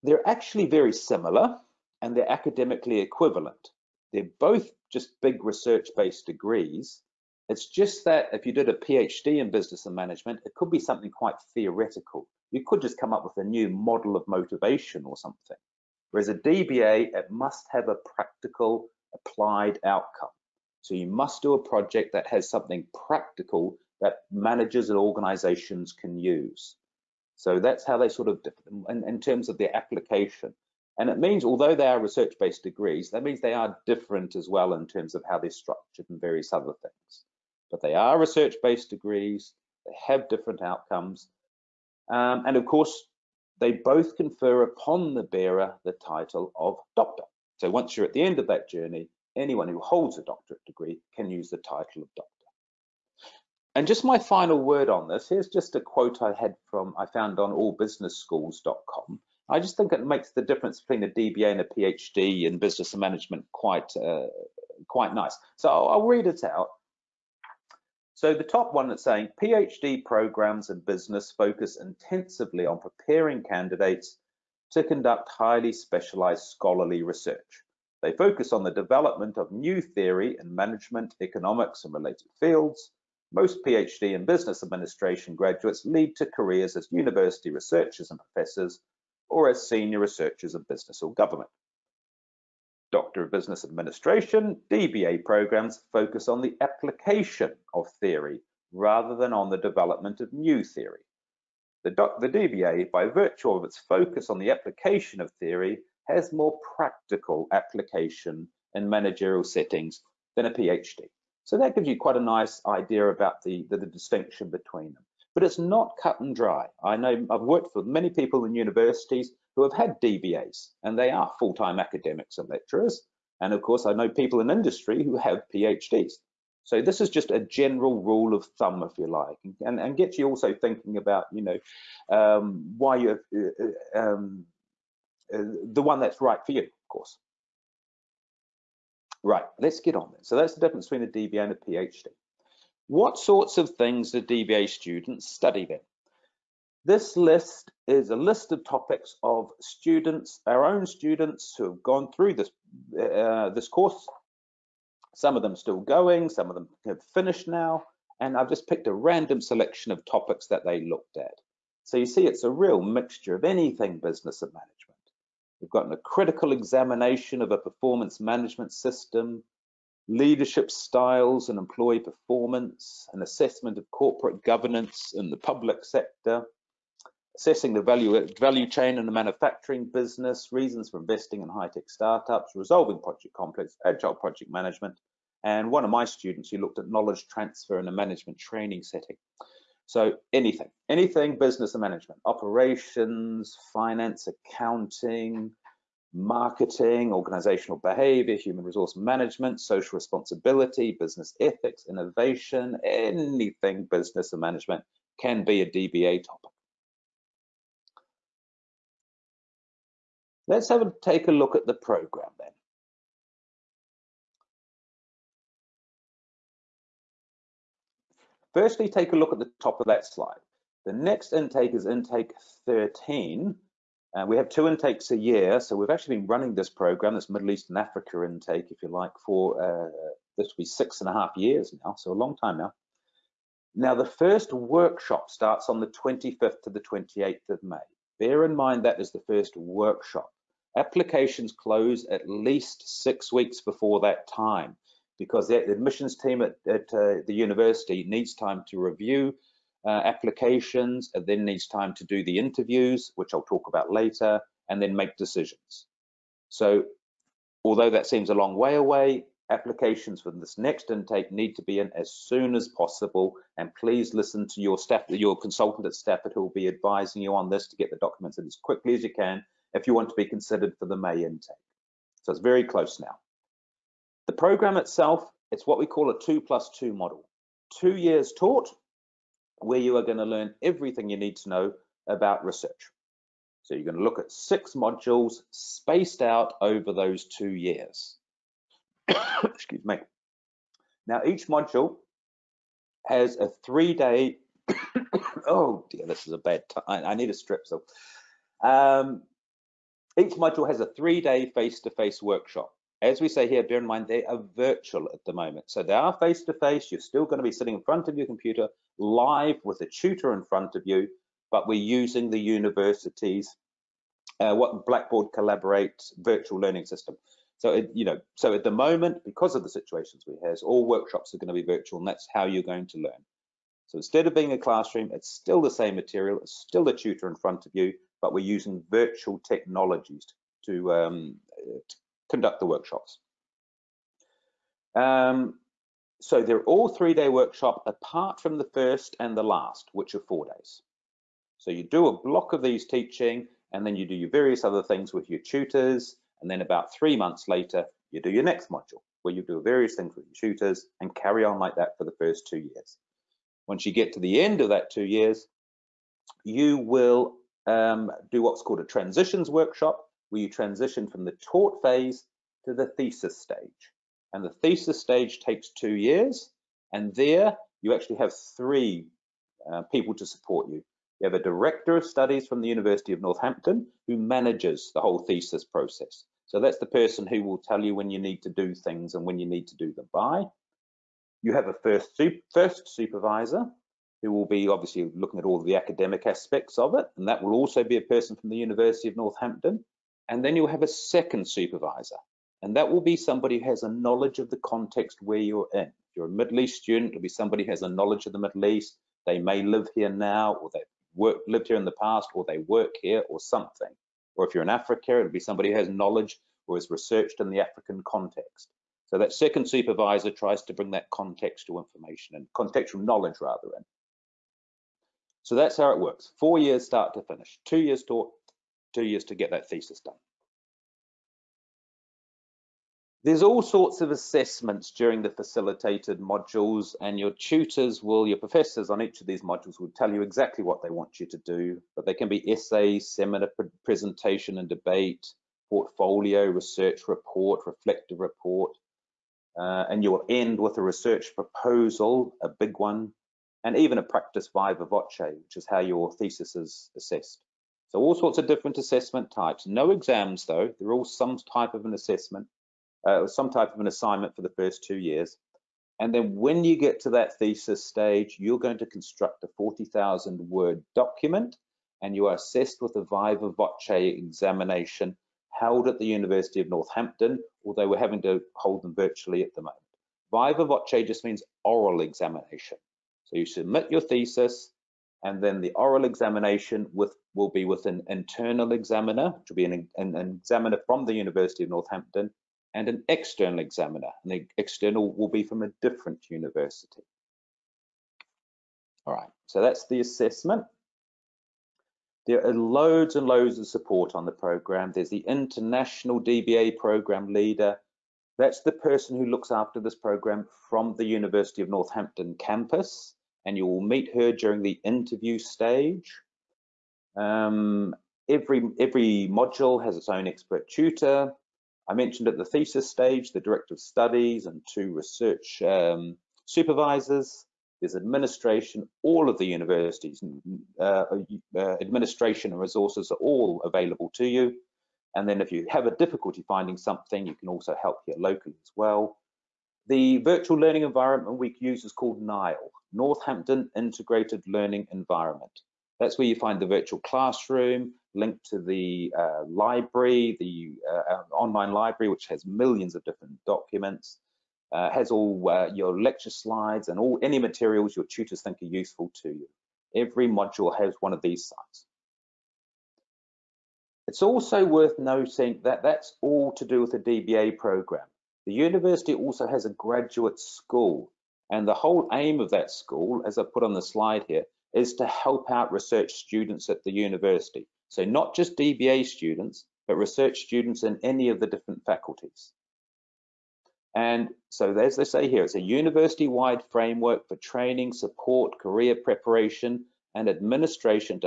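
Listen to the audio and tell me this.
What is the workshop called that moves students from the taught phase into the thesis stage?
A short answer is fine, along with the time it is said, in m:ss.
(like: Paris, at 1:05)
transitions workshop, at 5:58.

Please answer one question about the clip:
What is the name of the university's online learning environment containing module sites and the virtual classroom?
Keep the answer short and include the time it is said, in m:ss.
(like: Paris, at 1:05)
NILE, at 8:52.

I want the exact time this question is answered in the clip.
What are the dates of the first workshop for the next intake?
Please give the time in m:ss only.
3:55.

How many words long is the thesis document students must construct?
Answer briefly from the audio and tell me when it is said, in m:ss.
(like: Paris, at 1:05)
40,000, at 7:39.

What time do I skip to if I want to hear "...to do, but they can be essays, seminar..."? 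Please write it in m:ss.
7:11.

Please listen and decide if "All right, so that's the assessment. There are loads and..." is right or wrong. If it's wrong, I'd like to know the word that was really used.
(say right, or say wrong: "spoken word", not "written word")
right.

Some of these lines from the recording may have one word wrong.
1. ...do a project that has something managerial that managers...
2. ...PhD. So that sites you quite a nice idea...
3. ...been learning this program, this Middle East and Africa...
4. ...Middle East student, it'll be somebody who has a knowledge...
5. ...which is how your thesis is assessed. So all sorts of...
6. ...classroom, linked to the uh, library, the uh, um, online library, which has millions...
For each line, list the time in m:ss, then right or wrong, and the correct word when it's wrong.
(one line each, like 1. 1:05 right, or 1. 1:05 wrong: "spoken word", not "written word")
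1. 0:21 wrong: "practical", not "managerial"
2. 1:50 wrong: "gives", not "sites"
3. 3:46 wrong: "running", not "learning"
4. 6:36 right
5. 7:25 right
6. 8:57 right.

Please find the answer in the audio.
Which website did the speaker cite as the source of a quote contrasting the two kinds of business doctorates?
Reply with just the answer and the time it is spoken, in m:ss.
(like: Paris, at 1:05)
allbusinessschools.com, at 0:57.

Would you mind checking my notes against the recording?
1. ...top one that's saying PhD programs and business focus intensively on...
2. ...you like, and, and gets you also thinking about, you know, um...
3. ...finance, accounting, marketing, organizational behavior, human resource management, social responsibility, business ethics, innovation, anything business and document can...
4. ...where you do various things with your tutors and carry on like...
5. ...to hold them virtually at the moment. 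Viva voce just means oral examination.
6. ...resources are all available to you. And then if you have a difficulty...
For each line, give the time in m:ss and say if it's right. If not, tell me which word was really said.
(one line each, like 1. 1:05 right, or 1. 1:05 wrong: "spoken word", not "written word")
1. 1:08 right
2. 2:08 right
3. 3:13 wrong: "management", not "document"
4. 5:49 right
5. 7:48 right
6. 8:42 right.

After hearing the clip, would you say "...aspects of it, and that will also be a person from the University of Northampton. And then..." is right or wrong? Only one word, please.
right.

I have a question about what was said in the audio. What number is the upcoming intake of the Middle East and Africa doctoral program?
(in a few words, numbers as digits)
13.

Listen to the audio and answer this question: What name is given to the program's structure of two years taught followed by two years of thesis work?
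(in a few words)
two plus two model.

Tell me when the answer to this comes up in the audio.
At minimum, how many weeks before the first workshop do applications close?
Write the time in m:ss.
4:03.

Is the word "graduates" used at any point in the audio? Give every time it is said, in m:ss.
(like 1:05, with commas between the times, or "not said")
1:25, 9:19.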